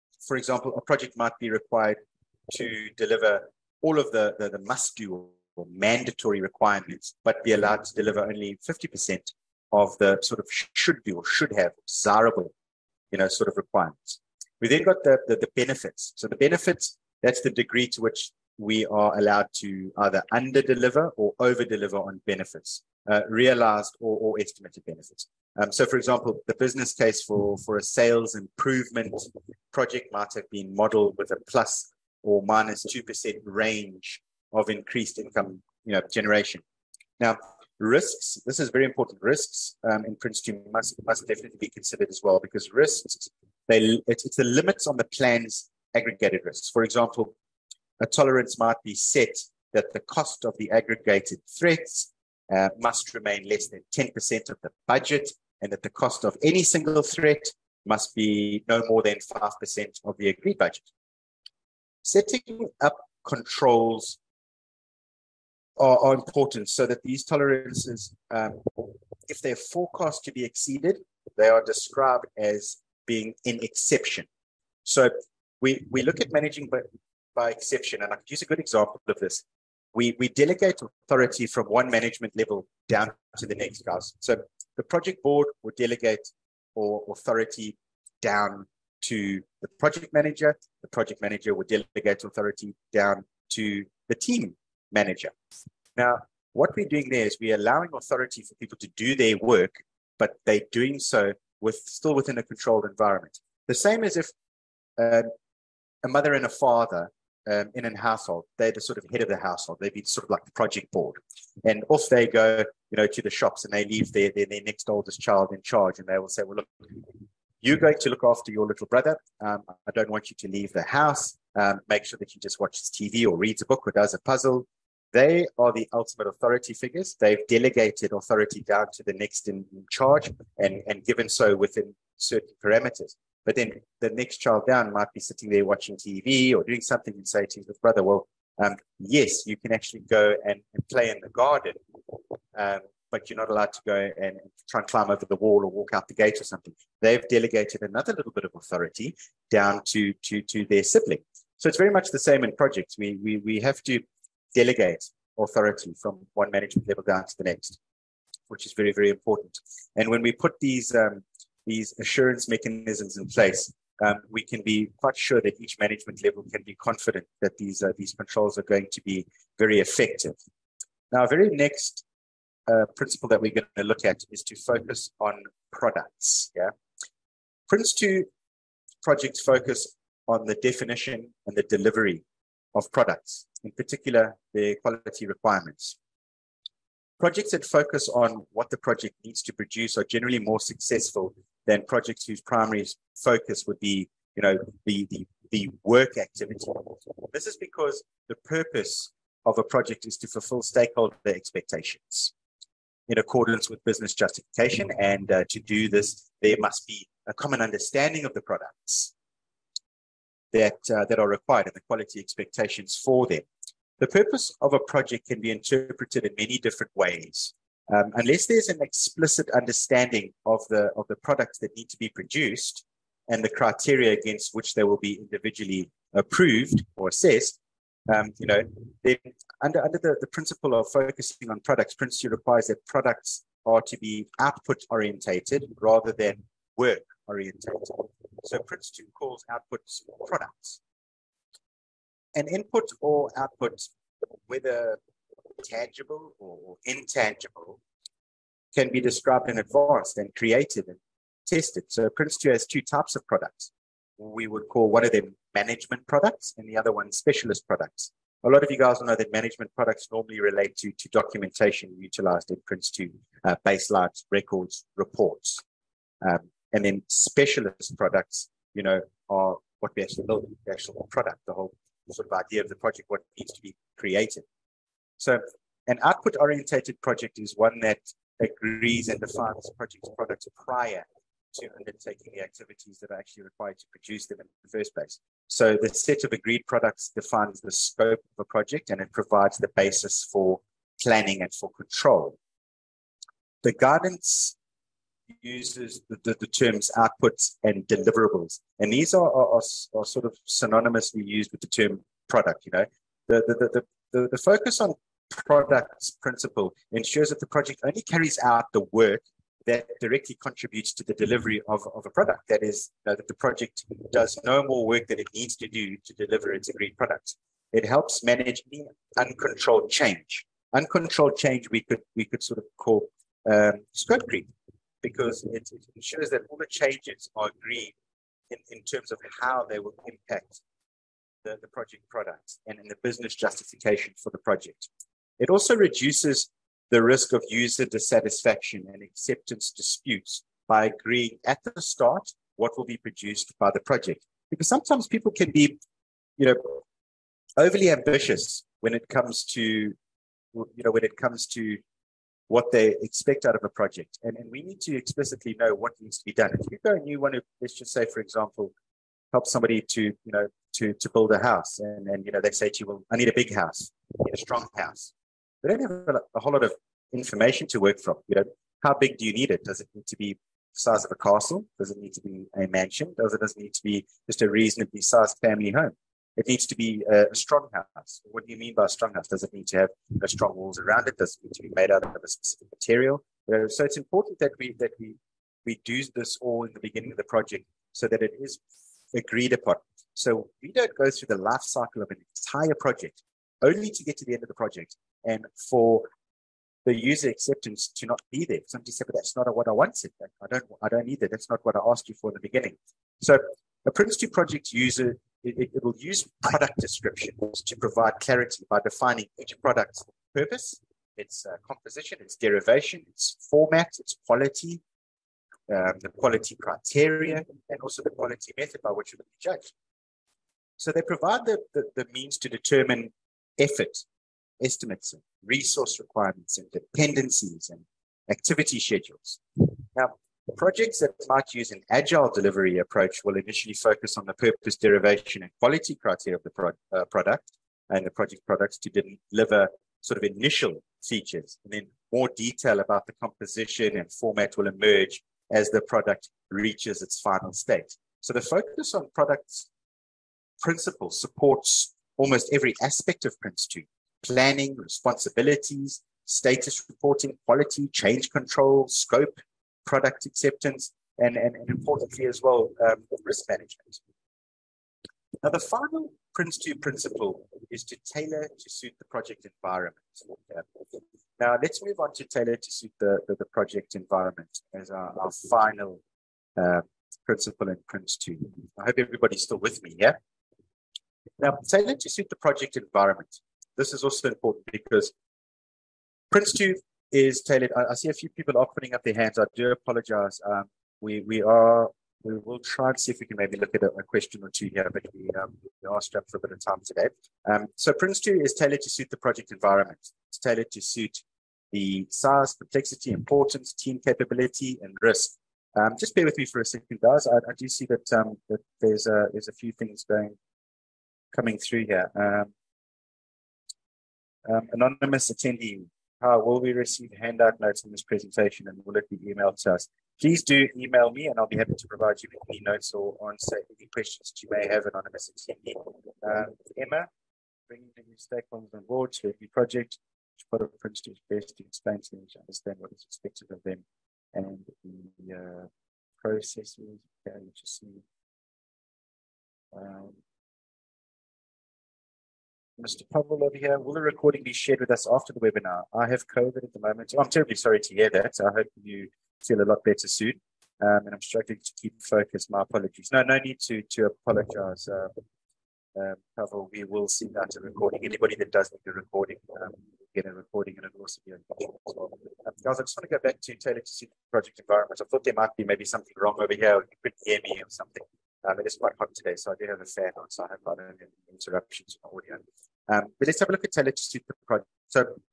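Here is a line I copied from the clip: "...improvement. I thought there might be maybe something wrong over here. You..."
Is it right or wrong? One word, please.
wrong.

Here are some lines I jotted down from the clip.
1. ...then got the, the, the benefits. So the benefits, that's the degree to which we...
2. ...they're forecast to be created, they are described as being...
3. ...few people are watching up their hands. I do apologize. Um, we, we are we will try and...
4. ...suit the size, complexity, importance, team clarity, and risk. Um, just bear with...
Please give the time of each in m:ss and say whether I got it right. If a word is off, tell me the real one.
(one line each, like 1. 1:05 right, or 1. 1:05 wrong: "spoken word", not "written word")
1. 0:14 right
2. 1:09 wrong: "exceeded", not "created"
3. 8:08 wrong: "putting", not "watching"
4. 8:20 wrong: "capability", not "clarity".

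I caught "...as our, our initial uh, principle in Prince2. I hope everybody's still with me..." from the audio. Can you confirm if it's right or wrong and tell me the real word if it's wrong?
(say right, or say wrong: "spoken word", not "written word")
wrong: "final", not "initial".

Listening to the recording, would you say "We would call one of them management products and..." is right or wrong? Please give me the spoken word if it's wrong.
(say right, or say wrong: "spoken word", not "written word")
right.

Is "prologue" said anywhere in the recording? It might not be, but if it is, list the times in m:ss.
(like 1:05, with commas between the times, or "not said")
not said.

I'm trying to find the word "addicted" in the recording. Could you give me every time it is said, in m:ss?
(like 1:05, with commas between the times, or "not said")
not said.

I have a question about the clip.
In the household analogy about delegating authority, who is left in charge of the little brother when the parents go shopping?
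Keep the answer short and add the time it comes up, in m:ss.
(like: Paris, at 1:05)
next oldest child, at 1:54.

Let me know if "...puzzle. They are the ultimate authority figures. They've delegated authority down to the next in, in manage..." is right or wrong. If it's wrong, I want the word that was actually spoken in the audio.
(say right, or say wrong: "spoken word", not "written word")
wrong: "charge", not "manage".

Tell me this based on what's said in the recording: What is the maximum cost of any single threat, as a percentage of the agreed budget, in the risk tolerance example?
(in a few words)
5%.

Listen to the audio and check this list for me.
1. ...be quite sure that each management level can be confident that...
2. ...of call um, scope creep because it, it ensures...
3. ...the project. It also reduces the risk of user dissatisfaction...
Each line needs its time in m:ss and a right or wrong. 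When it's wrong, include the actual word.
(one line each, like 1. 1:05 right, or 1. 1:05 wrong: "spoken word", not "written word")
1. 2:44 right
2. 5:22 right
3. 5:34 right.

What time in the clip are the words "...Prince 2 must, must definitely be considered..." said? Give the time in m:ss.
0:40.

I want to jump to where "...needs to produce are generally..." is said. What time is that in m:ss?
3:09.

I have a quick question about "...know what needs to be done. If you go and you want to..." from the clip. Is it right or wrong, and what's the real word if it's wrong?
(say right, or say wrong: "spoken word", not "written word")
right.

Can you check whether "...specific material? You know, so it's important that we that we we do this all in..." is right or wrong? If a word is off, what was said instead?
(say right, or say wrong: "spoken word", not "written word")
right.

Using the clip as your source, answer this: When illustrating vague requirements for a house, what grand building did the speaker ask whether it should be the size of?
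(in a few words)
a castle.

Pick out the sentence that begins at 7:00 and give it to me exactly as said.
So they provide the, the, the means to determine effort estimates and resource requirements and dependencies and activity schedules.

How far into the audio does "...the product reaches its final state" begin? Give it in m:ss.
7:25.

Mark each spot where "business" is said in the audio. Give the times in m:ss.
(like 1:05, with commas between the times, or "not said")
0:26, 3:23, 5:33.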